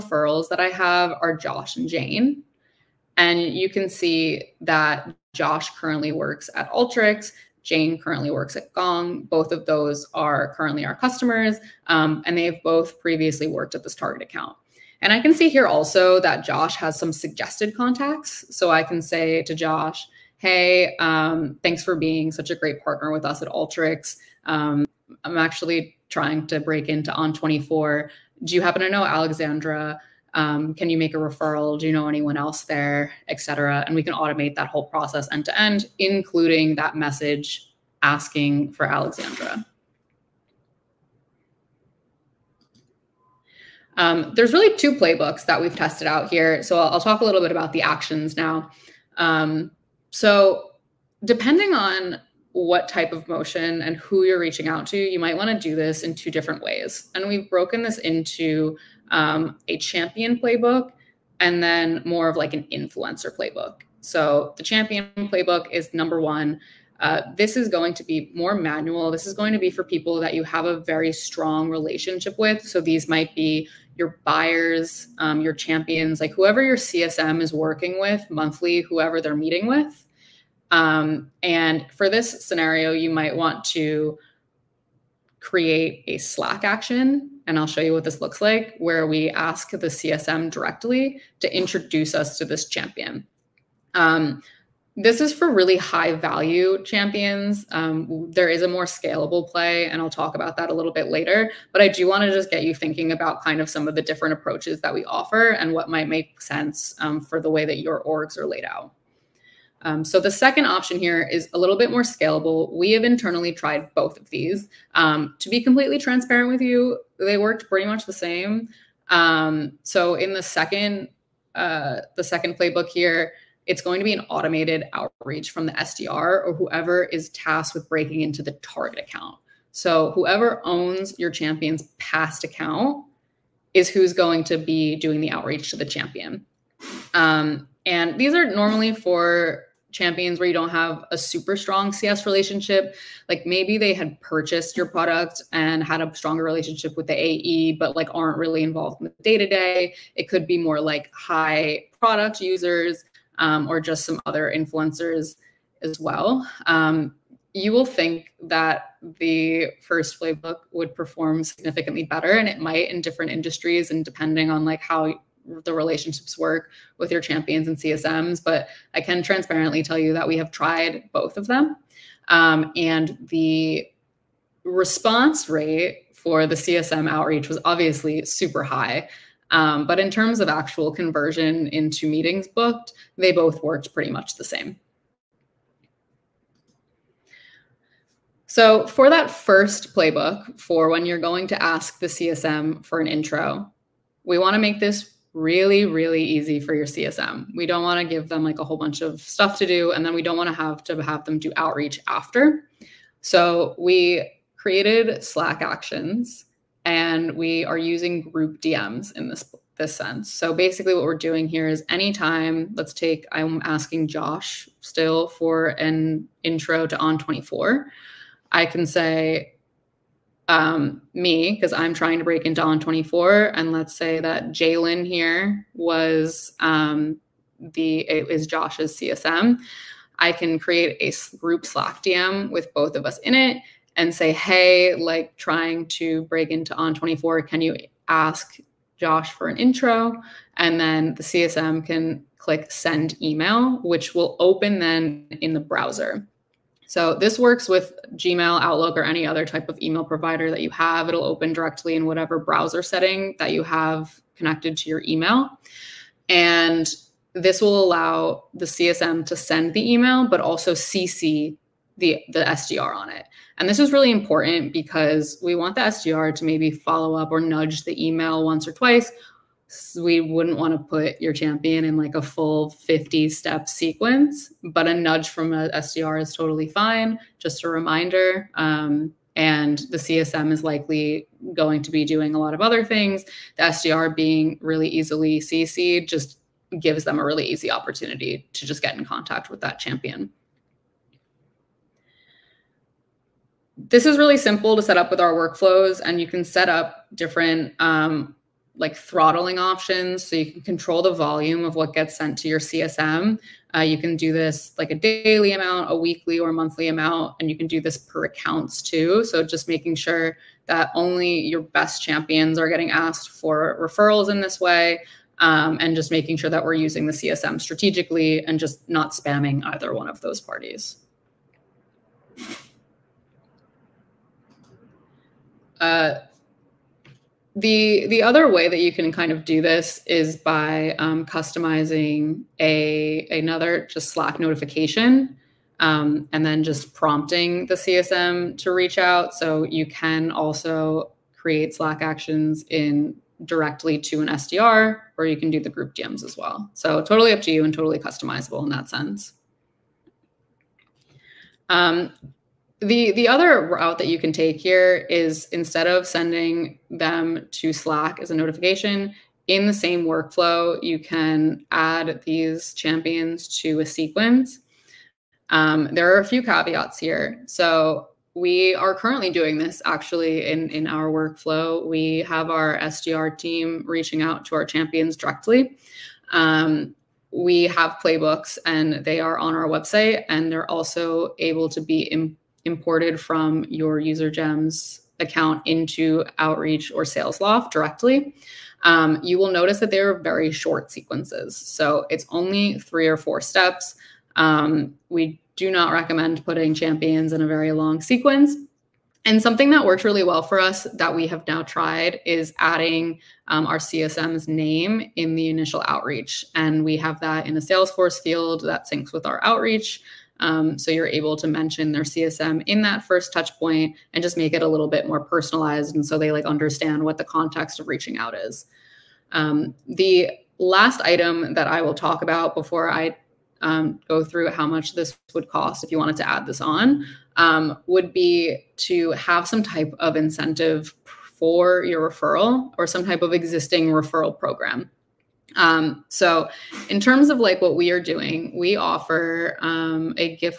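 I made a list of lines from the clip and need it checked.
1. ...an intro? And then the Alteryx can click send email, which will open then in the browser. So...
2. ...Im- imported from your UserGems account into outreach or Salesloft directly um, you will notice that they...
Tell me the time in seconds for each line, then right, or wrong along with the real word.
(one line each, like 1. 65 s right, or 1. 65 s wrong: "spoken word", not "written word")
1. 239 s wrong: "CSM", not "Alteryx"
2. 382 s right.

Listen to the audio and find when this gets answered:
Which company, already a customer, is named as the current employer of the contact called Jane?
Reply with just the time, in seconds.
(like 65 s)
8 s.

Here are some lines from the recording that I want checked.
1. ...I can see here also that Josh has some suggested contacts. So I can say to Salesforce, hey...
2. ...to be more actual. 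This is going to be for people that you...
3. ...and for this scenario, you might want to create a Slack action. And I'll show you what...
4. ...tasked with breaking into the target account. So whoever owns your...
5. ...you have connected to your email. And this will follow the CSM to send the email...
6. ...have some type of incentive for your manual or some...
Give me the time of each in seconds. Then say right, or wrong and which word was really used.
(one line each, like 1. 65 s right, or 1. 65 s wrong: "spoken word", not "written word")
1. 15 s wrong: "Josh", not "Salesforce"
2. 67 s wrong: "manual", not "actual"
3. 81 s right
4. 127 s right
5. 253 s wrong: "allow", not "follow"
6. 429 s wrong: "referral", not "manual".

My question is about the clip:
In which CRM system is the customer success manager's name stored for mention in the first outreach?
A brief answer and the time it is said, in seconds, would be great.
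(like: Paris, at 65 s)
Salesforce, at 407 s.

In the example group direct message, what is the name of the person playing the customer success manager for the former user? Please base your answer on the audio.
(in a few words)
Jalen.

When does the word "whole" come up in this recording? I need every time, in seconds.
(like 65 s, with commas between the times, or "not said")
34 s, 198 s.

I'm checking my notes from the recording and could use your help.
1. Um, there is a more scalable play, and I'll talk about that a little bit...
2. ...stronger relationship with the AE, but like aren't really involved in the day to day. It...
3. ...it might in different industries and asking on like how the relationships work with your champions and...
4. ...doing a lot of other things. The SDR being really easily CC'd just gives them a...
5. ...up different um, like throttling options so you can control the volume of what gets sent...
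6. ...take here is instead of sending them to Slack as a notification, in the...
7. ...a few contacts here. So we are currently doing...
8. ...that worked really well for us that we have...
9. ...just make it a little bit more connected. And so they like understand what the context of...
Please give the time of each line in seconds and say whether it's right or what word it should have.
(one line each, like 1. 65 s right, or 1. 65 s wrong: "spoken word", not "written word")
1. 97 s right
2. 146 s right
3. 162 s wrong: "depending", not "asking"
4. 282 s right
5. 296 s right
6. 354 s right
7. 366 s wrong: "caveats", not "contacts"
8. 399 s right
9. 414 s wrong: "personalized", not "connected".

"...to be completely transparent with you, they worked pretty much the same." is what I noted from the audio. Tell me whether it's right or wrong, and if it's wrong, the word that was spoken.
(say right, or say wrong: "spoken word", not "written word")
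right.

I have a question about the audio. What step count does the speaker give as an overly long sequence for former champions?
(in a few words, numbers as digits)
50.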